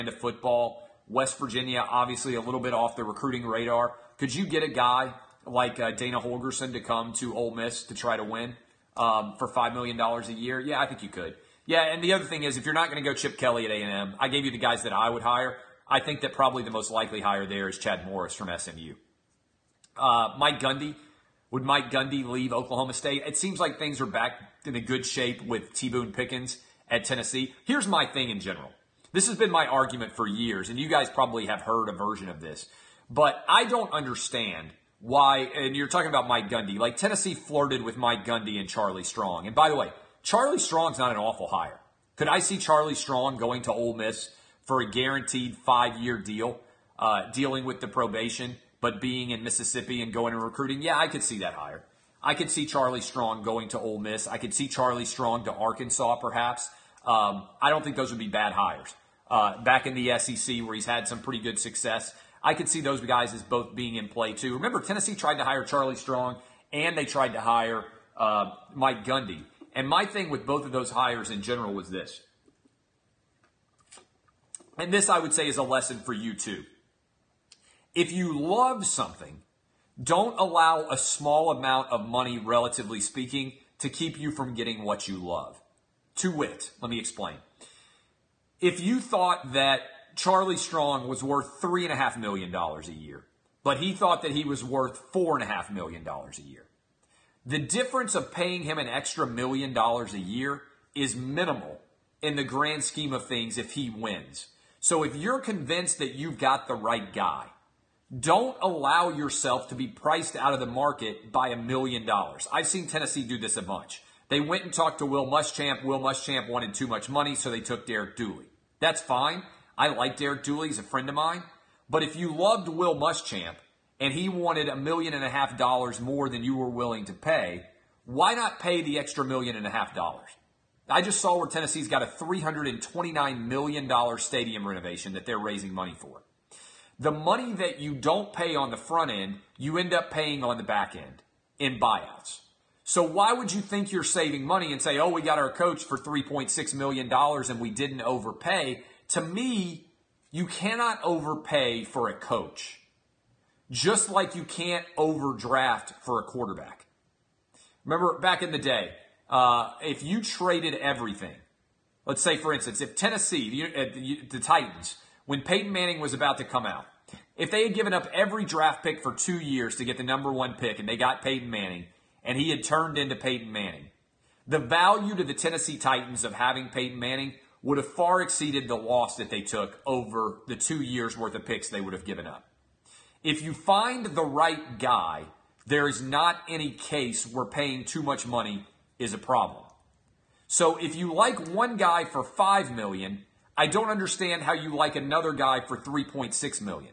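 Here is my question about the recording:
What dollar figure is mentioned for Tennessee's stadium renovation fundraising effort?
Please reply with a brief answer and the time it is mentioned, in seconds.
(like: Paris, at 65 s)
$329 million, at 132 s.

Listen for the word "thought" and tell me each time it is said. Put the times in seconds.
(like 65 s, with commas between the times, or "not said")
89 s, 93 s.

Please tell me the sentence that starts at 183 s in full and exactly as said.
If you find the right guy, there is not any case where paying too much money is a problem.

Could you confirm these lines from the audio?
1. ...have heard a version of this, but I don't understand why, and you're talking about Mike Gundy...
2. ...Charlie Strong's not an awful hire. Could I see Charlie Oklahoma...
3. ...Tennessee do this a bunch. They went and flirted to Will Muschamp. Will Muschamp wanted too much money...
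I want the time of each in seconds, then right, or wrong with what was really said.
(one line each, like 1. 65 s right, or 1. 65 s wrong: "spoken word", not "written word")
1. 31 s right
2. 40 s wrong: "Strong", not "Oklahoma"
3. 112 s wrong: "talked", not "flirted".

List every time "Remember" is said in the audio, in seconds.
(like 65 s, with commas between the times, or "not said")
64 s, 157 s.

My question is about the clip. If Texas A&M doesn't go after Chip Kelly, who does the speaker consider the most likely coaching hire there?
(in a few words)
Chad Morris.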